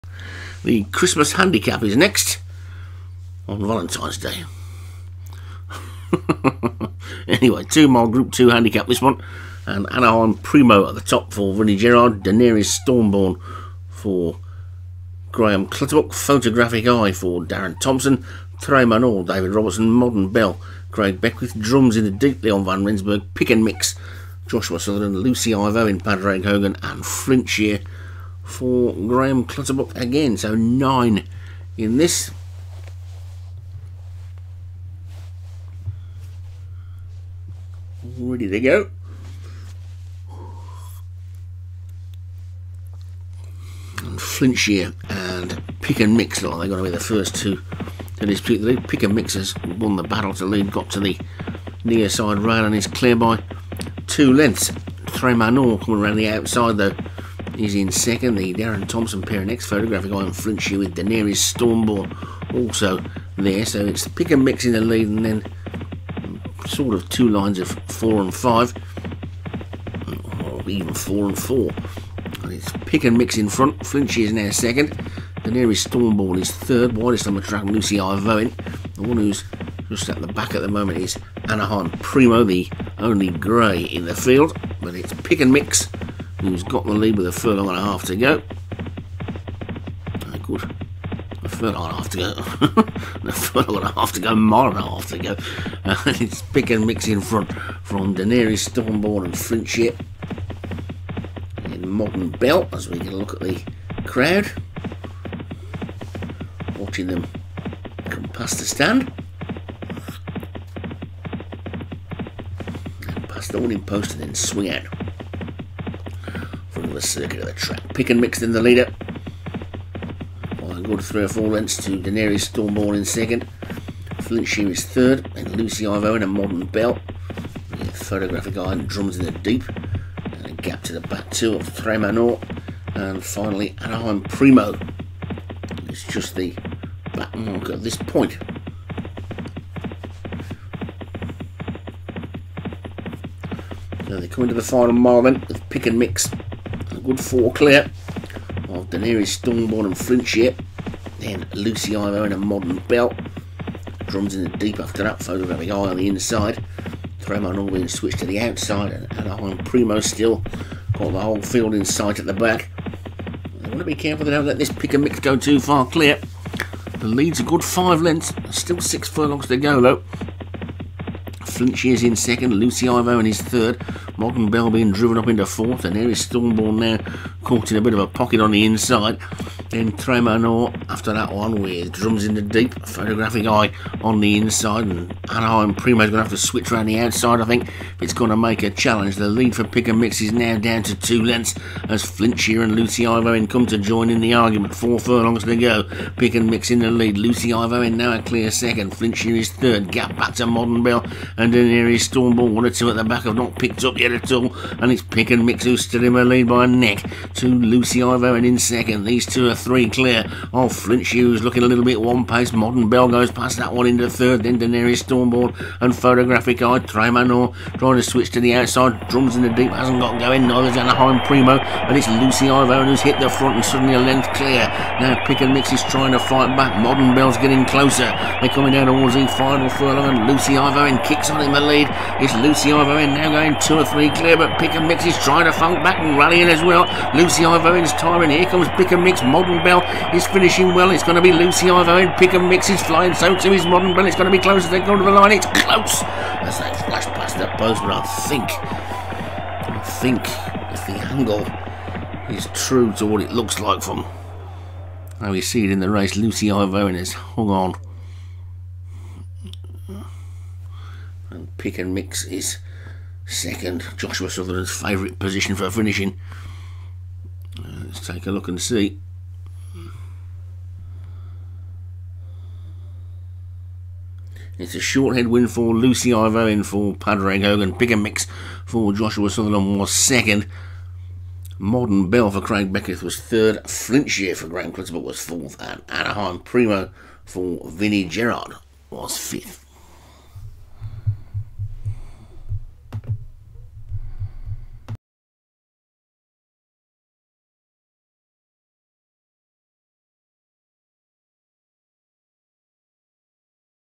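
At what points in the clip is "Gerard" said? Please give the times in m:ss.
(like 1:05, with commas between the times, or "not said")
0:11, 4:48.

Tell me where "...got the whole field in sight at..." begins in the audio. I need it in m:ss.
2:40.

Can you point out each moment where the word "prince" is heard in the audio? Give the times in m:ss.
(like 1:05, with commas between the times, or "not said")
not said.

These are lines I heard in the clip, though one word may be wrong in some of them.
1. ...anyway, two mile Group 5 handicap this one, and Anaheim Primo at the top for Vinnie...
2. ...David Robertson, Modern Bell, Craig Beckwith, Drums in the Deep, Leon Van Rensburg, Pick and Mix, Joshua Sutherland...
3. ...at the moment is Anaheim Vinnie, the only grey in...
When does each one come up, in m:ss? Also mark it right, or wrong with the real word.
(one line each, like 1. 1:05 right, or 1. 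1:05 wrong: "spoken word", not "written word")
1. 0:07 wrong: "2", not "5"
2. 0:19 right
3. 1:20 wrong: "Primo", not "Vinnie".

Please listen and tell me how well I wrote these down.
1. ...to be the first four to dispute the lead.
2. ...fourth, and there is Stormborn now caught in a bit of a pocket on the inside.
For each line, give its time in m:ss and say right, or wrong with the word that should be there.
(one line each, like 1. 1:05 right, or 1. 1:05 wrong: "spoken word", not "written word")
1. 0:46 wrong: "two", not "four"
2. 2:55 right.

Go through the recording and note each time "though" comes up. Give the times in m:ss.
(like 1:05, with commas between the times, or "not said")
0:56, 2:49.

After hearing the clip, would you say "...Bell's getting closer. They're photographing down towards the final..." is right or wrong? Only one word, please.
wrong.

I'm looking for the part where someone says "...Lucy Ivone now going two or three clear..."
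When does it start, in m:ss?
3:52.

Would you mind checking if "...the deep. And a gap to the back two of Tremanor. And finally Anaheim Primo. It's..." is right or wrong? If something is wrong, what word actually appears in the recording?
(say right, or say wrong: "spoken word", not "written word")
right.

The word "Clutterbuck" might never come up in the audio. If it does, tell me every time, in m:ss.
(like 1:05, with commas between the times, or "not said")
0:15, 0:29, 4:44.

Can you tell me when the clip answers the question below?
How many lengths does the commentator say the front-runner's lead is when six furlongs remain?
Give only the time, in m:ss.
2:47.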